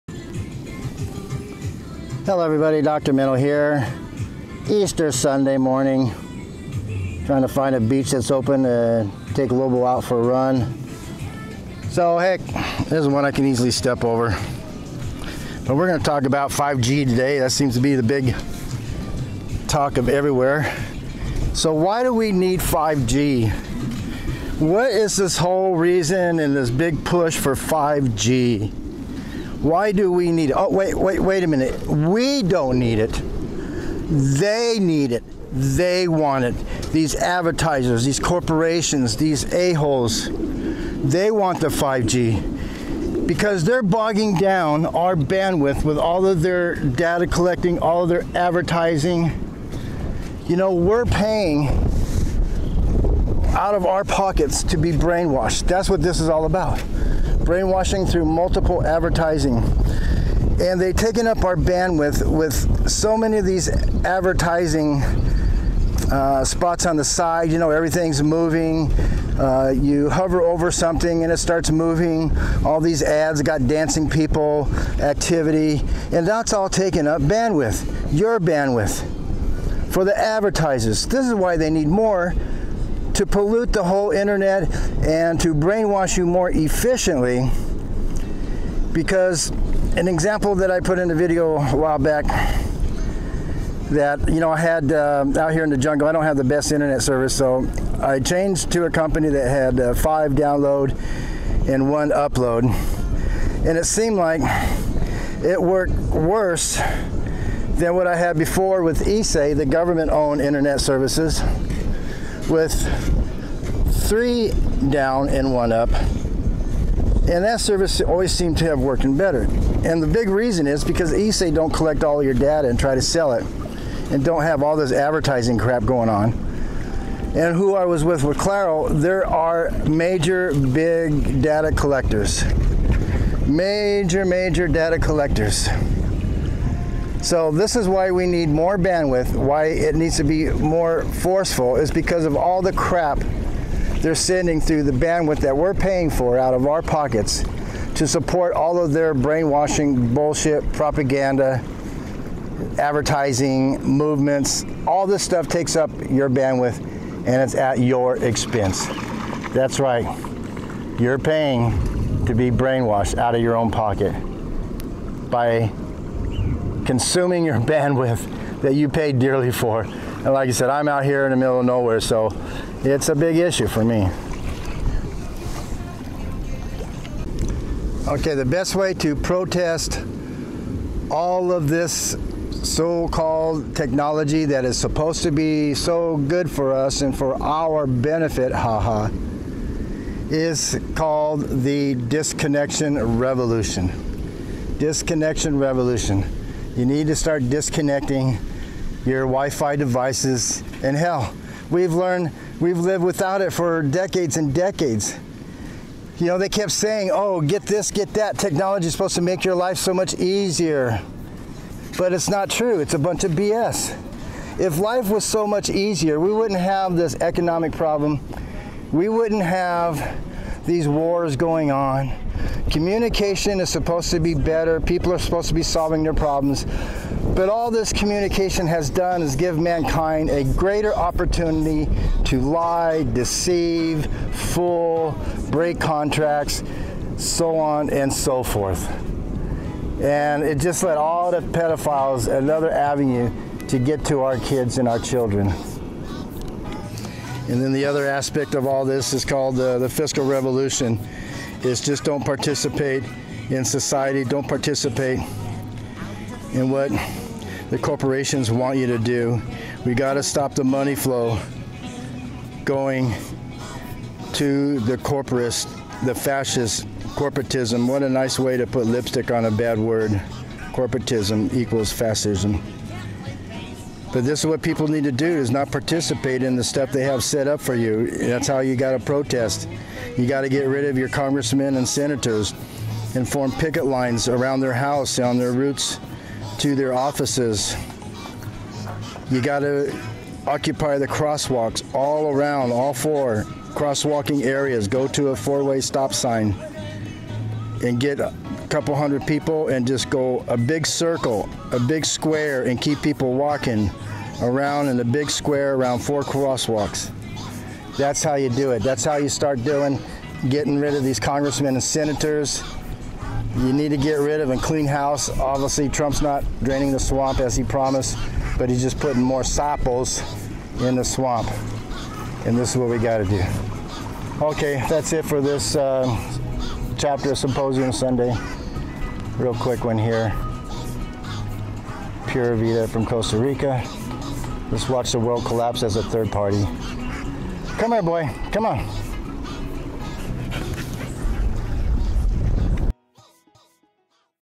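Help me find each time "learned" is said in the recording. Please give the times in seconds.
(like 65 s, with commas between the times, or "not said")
201 s.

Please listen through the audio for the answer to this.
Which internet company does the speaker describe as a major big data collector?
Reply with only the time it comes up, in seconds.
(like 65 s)
128 s.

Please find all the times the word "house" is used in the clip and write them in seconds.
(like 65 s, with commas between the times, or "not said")
284 s, 314 s.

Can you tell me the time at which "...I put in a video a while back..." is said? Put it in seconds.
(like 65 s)
90 s.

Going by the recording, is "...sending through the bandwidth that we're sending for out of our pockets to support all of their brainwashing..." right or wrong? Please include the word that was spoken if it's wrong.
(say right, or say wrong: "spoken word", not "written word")
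wrong: "paying", not "sending".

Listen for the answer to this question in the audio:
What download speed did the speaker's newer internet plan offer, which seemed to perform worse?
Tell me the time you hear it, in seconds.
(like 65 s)
99 s.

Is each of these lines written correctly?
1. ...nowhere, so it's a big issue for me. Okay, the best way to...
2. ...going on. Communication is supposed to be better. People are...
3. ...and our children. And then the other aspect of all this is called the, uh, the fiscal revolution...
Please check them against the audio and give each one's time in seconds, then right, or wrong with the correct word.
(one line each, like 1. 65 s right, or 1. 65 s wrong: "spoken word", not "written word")
1. 171 s right
2. 221 s right
3. 244 s right.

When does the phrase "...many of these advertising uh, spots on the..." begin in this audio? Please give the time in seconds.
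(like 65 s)
63 s.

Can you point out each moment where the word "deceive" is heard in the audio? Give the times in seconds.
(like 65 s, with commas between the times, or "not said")
233 s.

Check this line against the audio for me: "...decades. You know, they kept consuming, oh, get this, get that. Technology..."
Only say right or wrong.
wrong.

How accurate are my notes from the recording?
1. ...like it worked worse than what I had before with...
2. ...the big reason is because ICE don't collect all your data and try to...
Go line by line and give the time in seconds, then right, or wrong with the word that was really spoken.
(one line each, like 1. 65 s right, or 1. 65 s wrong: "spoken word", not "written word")
1. 104 s right
2. 120 s right.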